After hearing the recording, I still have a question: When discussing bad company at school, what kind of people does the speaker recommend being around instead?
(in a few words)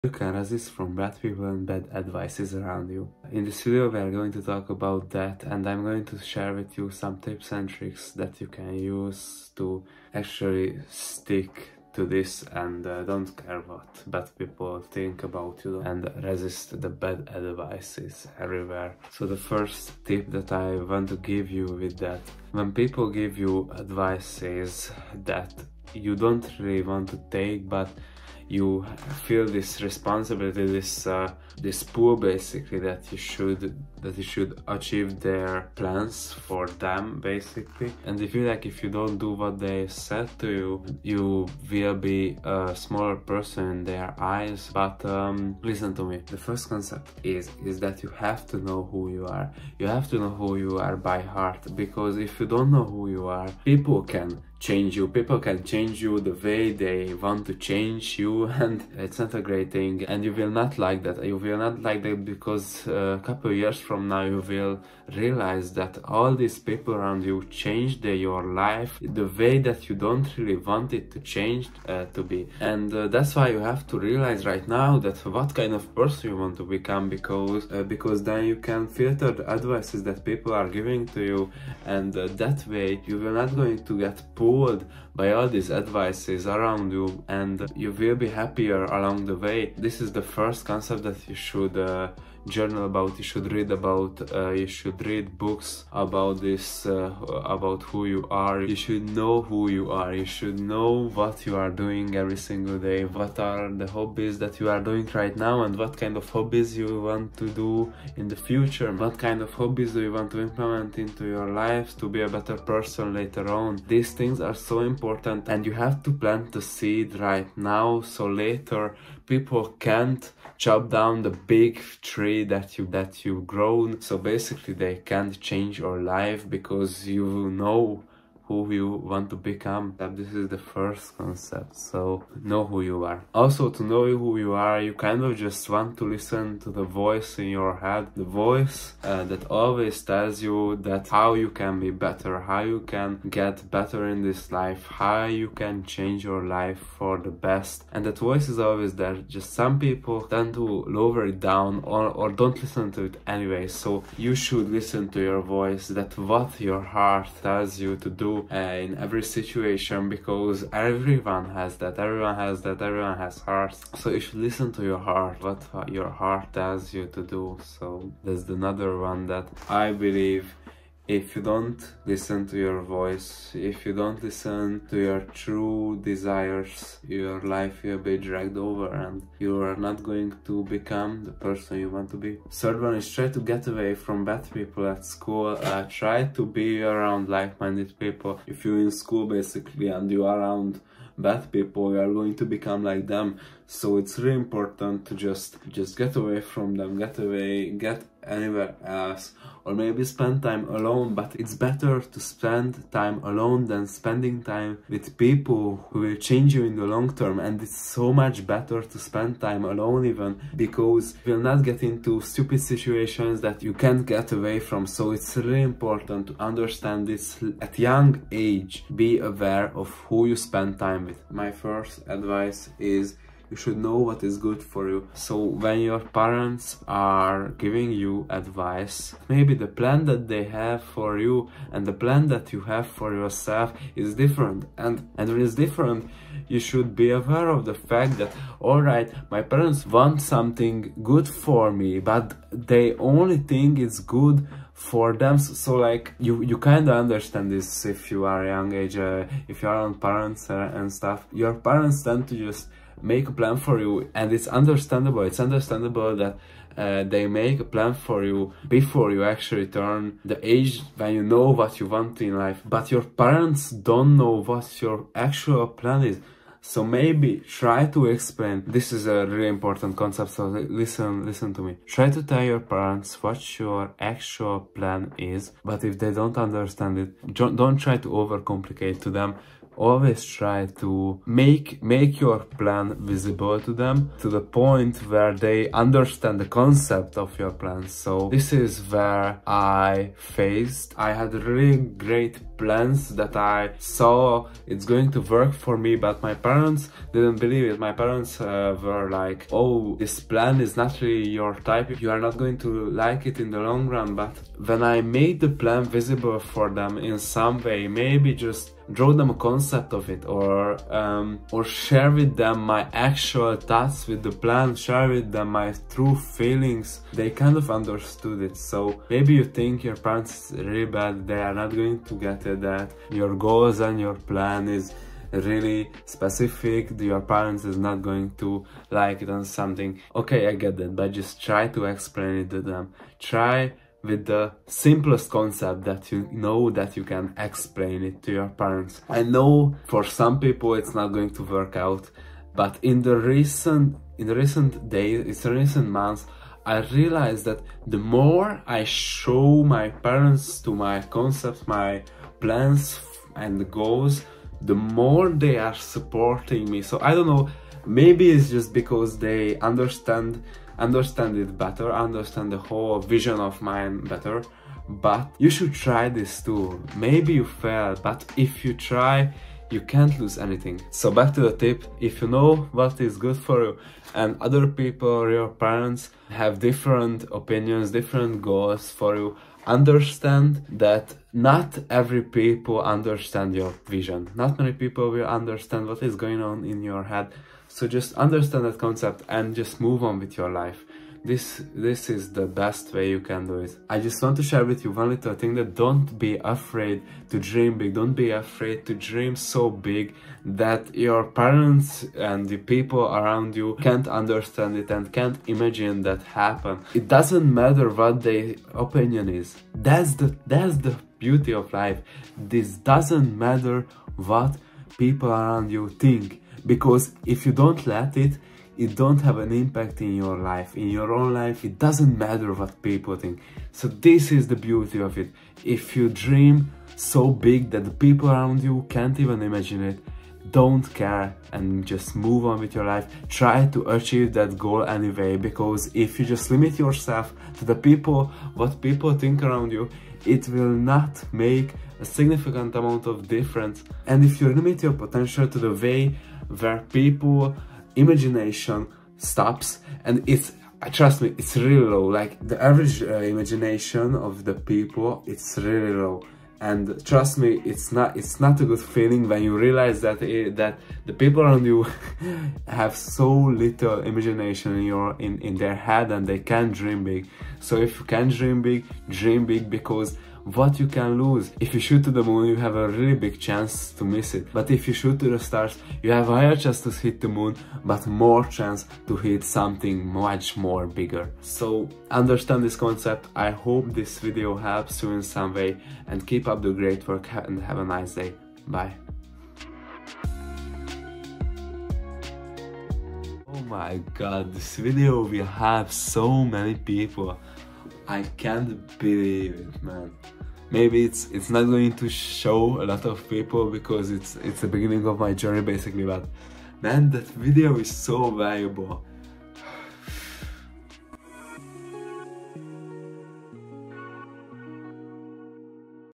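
like-minded people.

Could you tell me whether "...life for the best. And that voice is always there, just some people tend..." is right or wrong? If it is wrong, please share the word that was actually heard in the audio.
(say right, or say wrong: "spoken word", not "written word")
right.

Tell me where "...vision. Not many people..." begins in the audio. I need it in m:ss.
6:23.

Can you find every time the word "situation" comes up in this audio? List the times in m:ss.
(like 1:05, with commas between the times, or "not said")
2:39, 3:32.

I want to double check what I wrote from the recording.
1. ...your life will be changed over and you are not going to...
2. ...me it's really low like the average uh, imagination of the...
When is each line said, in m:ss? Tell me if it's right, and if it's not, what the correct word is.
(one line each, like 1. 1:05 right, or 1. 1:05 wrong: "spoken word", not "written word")
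1. 2:57 wrong: "dragged", not "changed"
2. 7:31 right.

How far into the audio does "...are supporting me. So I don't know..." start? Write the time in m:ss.
5:55.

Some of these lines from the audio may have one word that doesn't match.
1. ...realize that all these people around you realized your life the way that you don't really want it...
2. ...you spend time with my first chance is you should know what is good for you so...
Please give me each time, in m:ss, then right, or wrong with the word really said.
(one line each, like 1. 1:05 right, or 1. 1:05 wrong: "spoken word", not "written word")
1. 1:05 wrong: "changed", not "realized"
2. 3:40 wrong: "advice", not "chance".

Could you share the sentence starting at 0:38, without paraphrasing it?
And they feel like if you don't do what they said to you, you will be a smaller person in their eyes.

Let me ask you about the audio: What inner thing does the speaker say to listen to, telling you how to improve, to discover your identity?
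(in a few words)
the voice in your head.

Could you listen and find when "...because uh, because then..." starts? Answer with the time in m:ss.
1:17.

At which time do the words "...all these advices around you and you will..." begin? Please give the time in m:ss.
1:25.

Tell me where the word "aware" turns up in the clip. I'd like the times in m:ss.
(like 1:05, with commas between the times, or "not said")
3:39, 3:57.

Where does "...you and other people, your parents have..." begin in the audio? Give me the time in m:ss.
6:13.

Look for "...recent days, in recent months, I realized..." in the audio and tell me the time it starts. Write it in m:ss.
5:44.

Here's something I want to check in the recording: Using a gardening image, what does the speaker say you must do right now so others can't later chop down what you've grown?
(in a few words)
plant the seed.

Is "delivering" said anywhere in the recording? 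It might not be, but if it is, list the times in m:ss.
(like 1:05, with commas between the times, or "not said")
not said.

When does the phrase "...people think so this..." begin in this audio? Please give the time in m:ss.
7:02.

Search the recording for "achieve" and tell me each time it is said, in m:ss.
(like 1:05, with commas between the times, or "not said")
0:34, 7:13.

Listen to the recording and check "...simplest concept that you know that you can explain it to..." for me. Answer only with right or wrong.
right.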